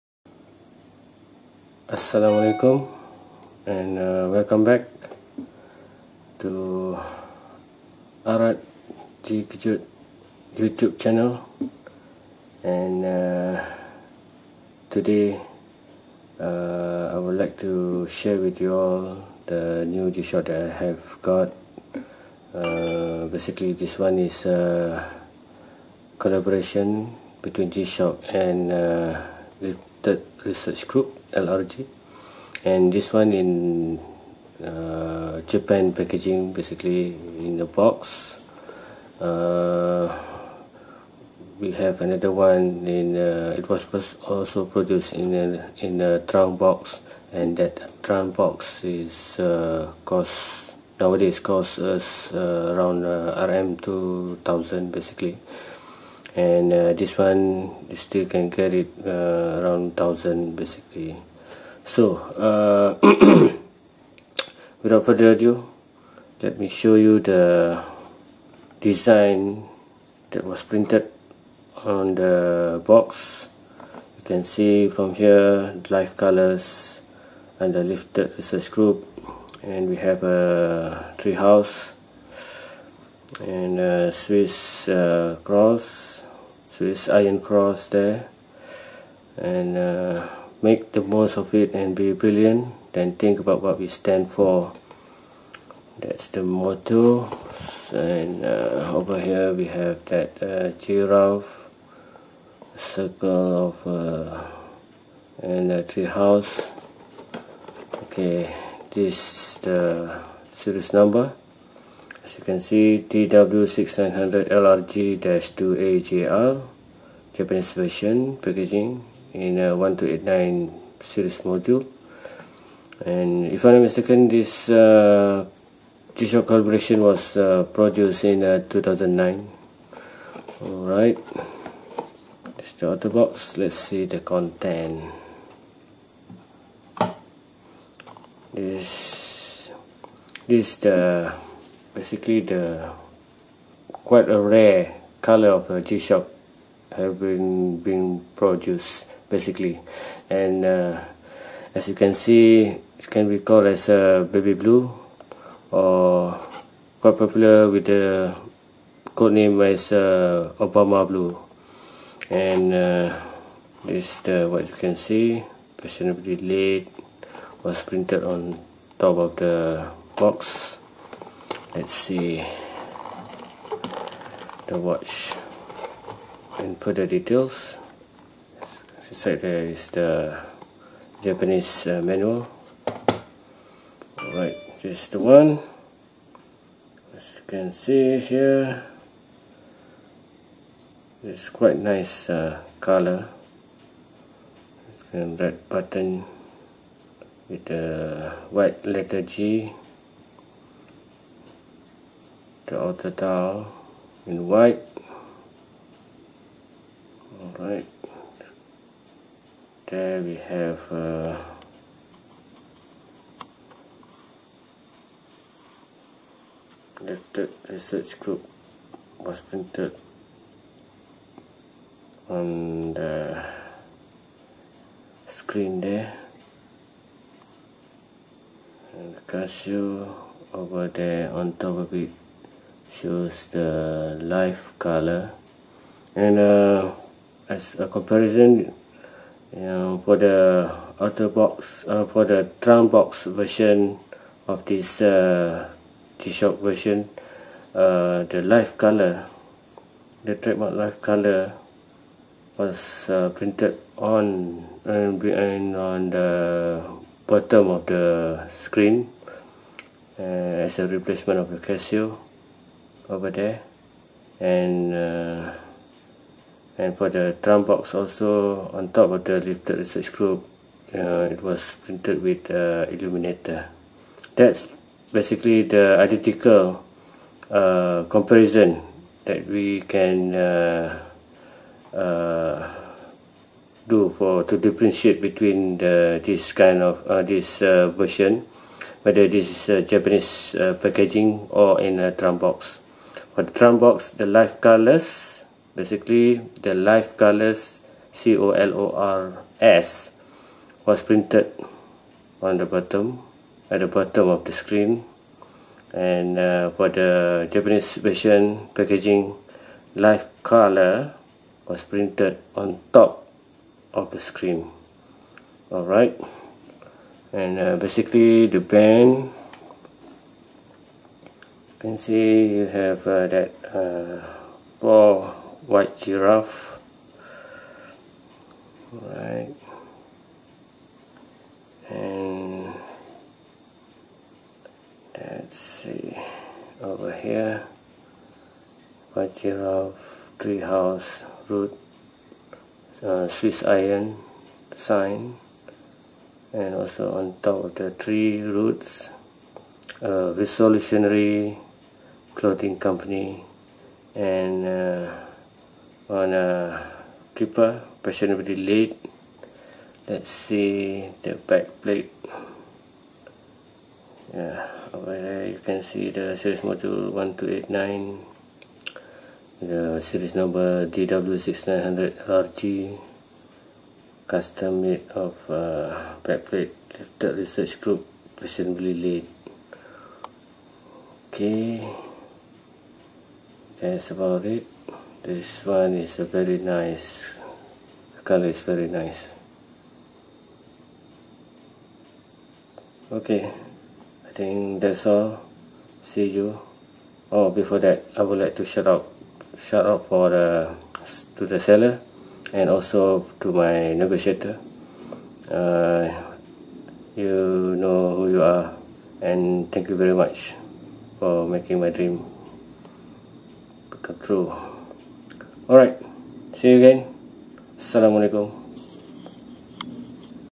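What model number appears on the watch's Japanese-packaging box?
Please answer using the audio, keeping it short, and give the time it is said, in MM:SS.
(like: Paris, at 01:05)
DW6900LRG-2AJR, at 01:53.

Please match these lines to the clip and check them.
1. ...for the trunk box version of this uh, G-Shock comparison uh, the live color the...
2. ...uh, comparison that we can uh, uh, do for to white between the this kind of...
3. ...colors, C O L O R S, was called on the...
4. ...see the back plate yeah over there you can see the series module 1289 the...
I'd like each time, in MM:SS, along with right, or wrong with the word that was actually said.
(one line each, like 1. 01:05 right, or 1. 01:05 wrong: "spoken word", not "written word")
1. 04:02 wrong: "version", not "comparison"
2. 04:37 wrong: "differentiate", not "white"
3. 04:57 wrong: "printed", not "called"
4. 06:00 right.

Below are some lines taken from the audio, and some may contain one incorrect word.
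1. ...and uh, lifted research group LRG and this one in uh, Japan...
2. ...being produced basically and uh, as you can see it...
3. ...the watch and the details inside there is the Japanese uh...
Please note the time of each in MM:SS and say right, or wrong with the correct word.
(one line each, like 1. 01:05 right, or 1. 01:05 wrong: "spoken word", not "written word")
1. 00:28 right
2. 02:27 right
3. 02:54 right.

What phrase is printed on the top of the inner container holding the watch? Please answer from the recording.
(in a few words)
fashionably late.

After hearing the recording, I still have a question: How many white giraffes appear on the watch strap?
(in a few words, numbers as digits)
4.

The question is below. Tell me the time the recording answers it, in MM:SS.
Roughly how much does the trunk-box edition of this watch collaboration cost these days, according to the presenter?
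00:53.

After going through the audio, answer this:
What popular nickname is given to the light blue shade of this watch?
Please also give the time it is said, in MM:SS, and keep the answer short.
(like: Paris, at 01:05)
Obama blue, at 02:40.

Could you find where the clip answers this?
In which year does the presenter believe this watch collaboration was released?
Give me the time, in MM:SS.
02:08.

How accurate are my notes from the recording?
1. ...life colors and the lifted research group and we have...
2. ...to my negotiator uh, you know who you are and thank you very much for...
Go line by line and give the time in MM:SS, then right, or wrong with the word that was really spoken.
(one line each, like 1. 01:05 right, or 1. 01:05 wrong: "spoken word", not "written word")
1. 01:15 right
2. 06:43 right.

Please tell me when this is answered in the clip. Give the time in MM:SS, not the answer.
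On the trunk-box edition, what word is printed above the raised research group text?
04:32.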